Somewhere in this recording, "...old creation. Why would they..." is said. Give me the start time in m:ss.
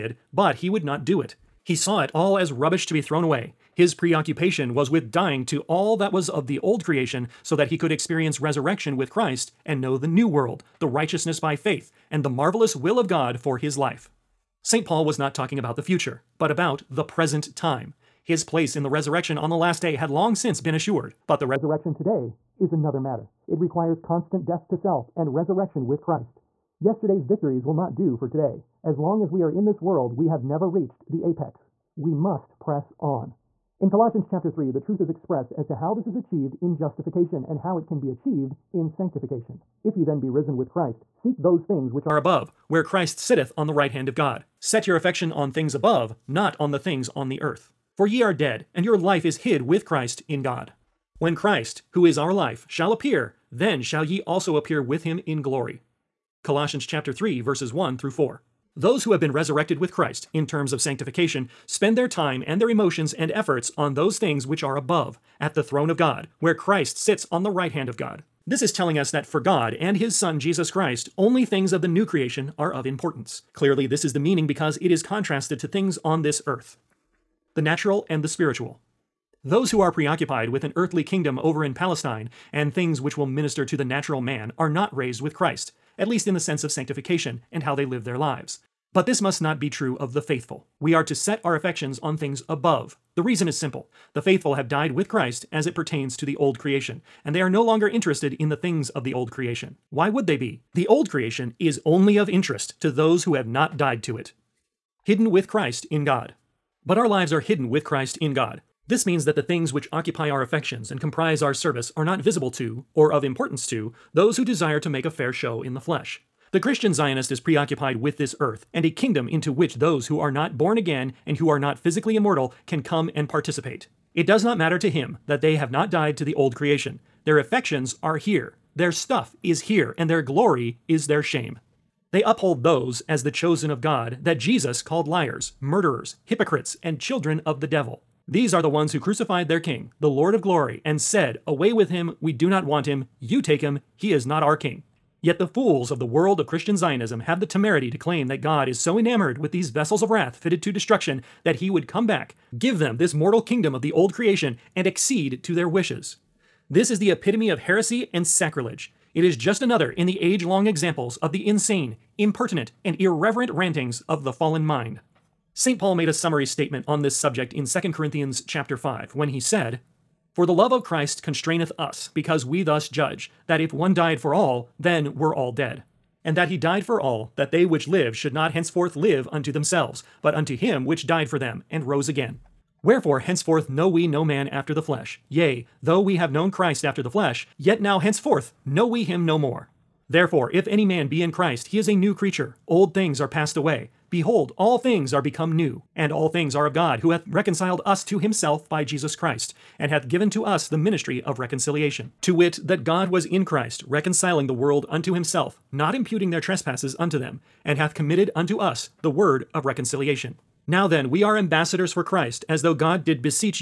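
1:39.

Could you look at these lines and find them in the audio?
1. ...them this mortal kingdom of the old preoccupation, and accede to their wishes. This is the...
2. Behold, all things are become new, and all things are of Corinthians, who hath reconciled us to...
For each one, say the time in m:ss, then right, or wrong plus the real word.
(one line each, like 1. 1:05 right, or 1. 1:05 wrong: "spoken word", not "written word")
1. 2:32 wrong: "creation", not "preoccupation"
2. 3:14 wrong: "God", not "Corinthians".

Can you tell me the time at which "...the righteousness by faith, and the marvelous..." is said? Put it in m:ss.
0:10.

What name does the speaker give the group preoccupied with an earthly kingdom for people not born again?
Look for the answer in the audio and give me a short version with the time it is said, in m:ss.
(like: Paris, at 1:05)
Christian Zionist, at 1:56.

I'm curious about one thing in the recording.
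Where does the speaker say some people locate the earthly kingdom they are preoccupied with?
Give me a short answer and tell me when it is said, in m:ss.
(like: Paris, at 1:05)
Palestine, at 1:21.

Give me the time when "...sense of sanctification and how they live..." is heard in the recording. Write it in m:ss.
1:26.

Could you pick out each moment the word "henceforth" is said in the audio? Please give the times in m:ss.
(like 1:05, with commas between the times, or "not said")
2:58, 3:03, 3:07.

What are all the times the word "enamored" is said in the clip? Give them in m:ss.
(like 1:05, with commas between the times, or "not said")
2:28.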